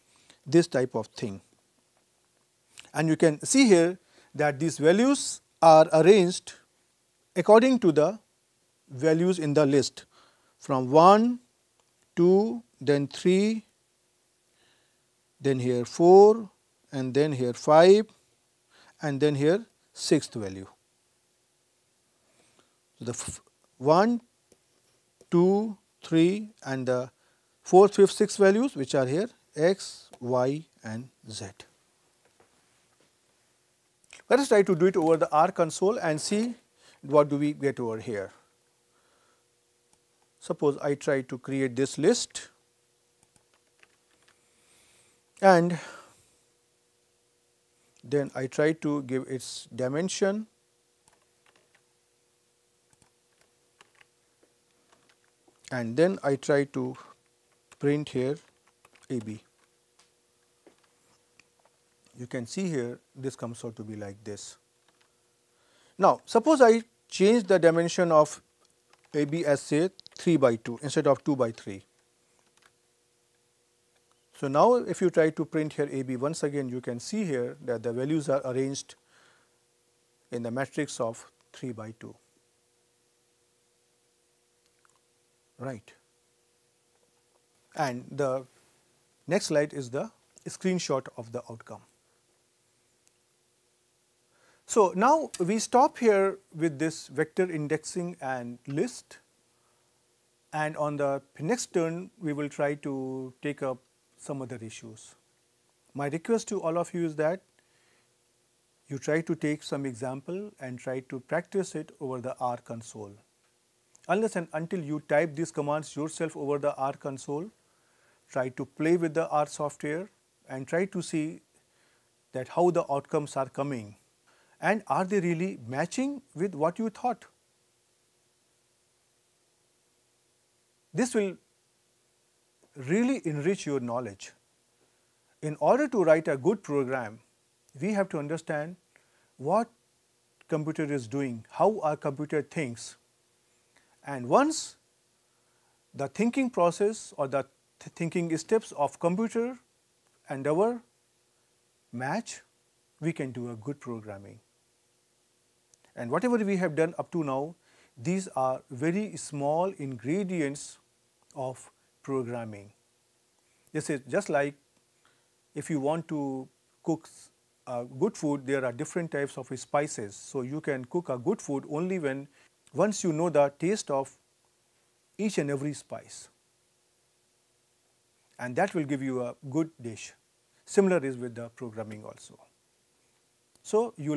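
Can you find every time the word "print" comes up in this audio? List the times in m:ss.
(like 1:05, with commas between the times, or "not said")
0:57, 1:15.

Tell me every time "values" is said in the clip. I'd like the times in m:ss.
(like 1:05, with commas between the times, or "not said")
0:04, 0:08, 0:20, 0:28, 1:17.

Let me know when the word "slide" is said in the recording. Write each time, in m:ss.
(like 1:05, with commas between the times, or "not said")
1:29.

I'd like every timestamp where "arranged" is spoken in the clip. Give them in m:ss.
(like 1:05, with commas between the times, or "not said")
0:05, 1:18.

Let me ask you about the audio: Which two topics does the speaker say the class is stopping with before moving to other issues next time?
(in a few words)
vector indexing and list.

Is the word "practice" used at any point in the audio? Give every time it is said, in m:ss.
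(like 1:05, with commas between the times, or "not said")
1:51.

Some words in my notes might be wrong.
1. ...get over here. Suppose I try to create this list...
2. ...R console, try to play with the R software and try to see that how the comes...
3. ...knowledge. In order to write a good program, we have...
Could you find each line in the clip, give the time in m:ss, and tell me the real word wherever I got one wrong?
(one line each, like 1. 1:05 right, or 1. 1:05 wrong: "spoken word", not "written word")
1. 0:37 right
2. 1:56 wrong: "outcomes", not "comes"
3. 2:13 right.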